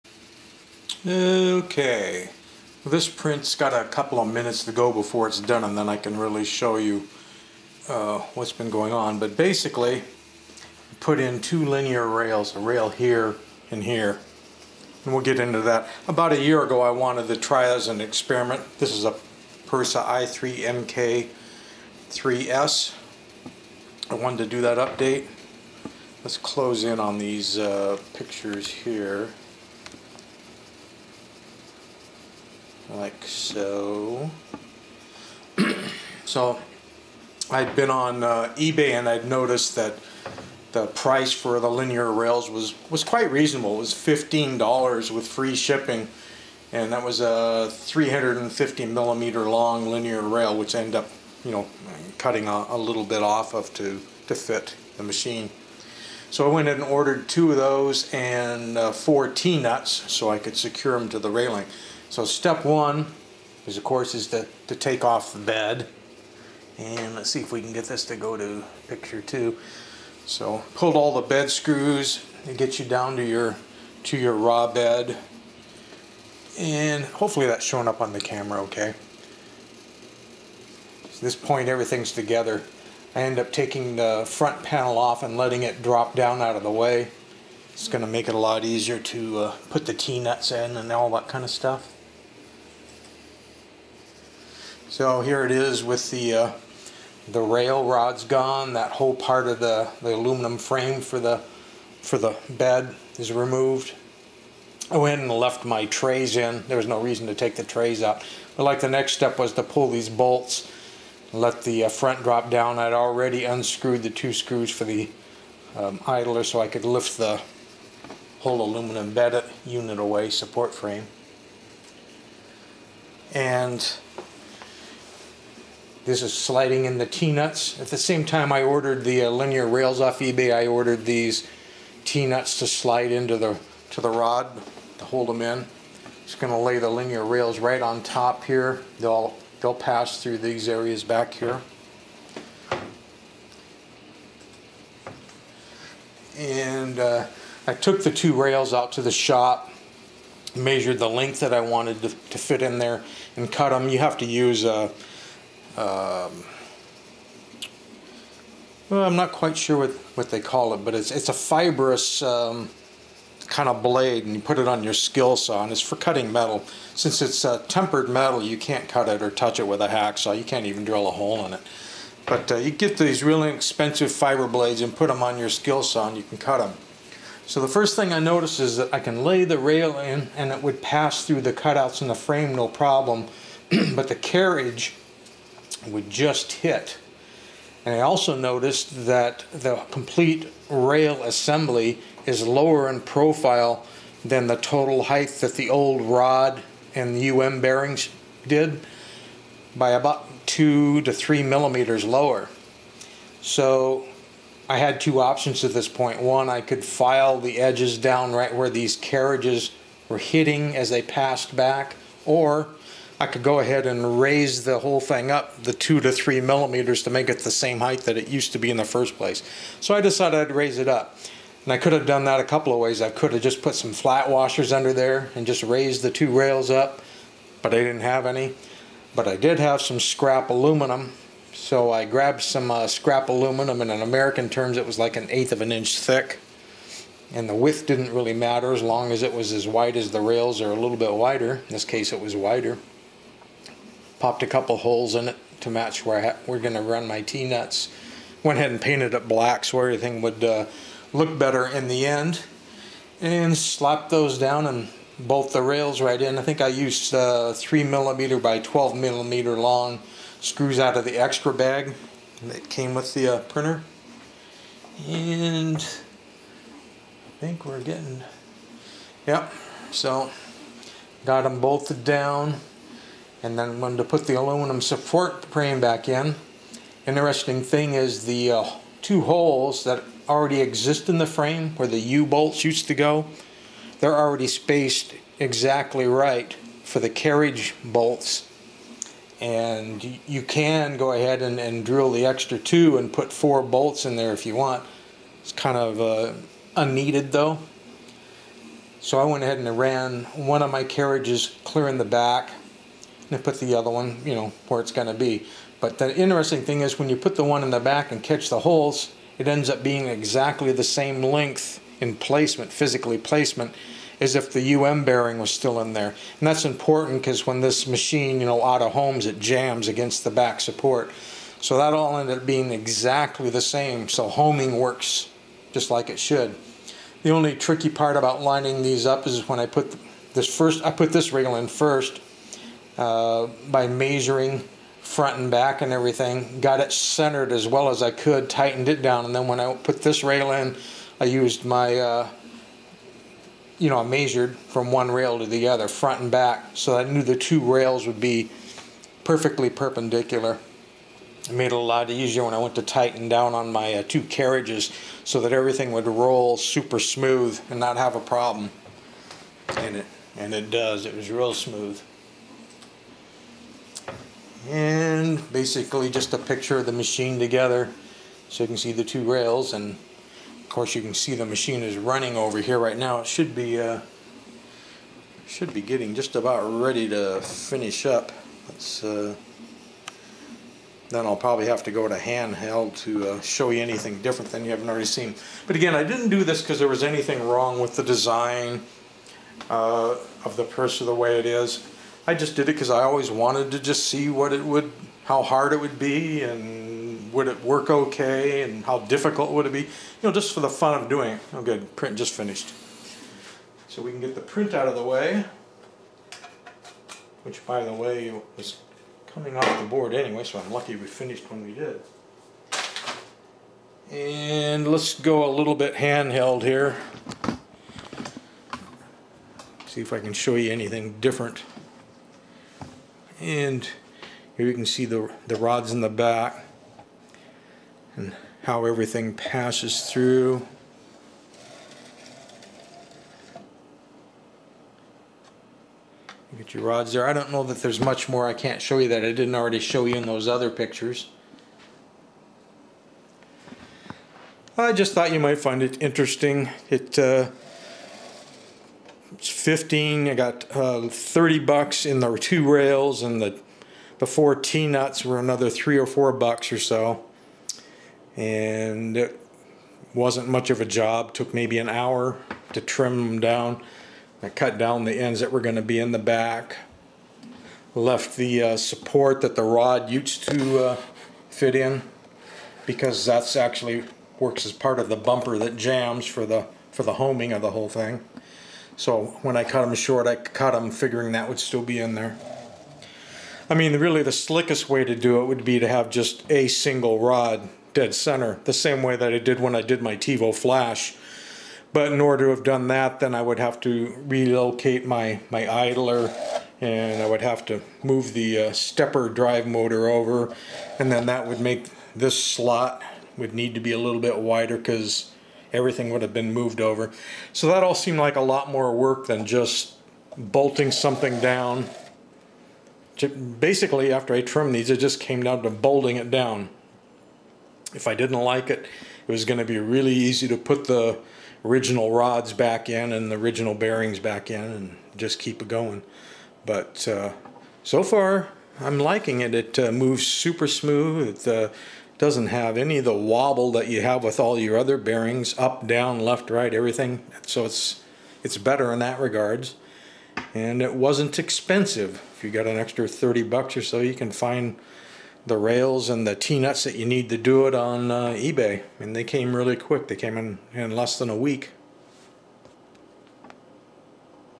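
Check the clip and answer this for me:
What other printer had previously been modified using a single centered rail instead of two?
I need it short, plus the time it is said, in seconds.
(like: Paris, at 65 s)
Tevo Flash, at 490 s.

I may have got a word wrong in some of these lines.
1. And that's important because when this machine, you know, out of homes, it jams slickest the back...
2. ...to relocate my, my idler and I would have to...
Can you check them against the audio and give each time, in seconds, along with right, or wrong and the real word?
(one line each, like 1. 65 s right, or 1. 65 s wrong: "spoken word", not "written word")
1. 316 s wrong: "against", not "slickest"
2. 493 s right.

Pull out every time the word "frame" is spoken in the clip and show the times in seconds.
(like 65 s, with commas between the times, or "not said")
100 s, 120 s, 182 s, 275 s, 281 s.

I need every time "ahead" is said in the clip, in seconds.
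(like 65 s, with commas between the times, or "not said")
213 s, 248 s, 291 s, 299 s.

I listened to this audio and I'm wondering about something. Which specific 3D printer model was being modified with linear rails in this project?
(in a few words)
Prusa i3MK3S.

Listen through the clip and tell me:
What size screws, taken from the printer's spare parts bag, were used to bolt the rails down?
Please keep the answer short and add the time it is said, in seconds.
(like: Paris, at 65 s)
3 mm by 12 mm, at 257 s.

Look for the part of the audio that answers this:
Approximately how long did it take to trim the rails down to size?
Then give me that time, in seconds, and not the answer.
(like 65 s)
461 s.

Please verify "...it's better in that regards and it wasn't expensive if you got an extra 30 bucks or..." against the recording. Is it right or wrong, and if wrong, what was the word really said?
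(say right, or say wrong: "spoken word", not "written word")
right.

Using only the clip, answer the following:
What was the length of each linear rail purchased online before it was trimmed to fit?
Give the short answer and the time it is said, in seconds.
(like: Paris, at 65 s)
350 millimeters, at 47 s.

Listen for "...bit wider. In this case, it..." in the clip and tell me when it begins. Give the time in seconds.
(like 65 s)
240 s.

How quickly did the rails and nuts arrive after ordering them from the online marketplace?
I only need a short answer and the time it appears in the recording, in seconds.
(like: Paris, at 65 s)
less than a week, at 550 s.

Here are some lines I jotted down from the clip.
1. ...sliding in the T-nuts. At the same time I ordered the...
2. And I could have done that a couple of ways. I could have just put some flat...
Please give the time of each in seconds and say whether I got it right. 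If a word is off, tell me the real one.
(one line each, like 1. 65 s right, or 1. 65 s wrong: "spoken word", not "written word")
1. 126 s right
2. 221 s right.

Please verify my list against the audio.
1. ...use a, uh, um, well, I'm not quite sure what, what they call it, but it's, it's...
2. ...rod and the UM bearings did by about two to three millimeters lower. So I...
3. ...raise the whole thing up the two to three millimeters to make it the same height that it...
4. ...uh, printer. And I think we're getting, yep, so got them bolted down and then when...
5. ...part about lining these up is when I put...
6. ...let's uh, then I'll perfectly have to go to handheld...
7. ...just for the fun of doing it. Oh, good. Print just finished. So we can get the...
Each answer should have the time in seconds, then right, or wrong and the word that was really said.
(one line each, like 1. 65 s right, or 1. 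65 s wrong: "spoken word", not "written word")
1. 154 s right
2. 196 s right
3. 214 s right
4. 263 s right
5. 327 s right
6. 378 s wrong: "probably", not "perfectly"
7. 400 s right.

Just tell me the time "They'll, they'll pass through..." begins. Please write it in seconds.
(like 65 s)
138 s.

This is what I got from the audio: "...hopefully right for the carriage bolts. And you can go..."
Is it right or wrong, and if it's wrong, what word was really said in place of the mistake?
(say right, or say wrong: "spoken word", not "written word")
wrong: "exactly", not "hopefully".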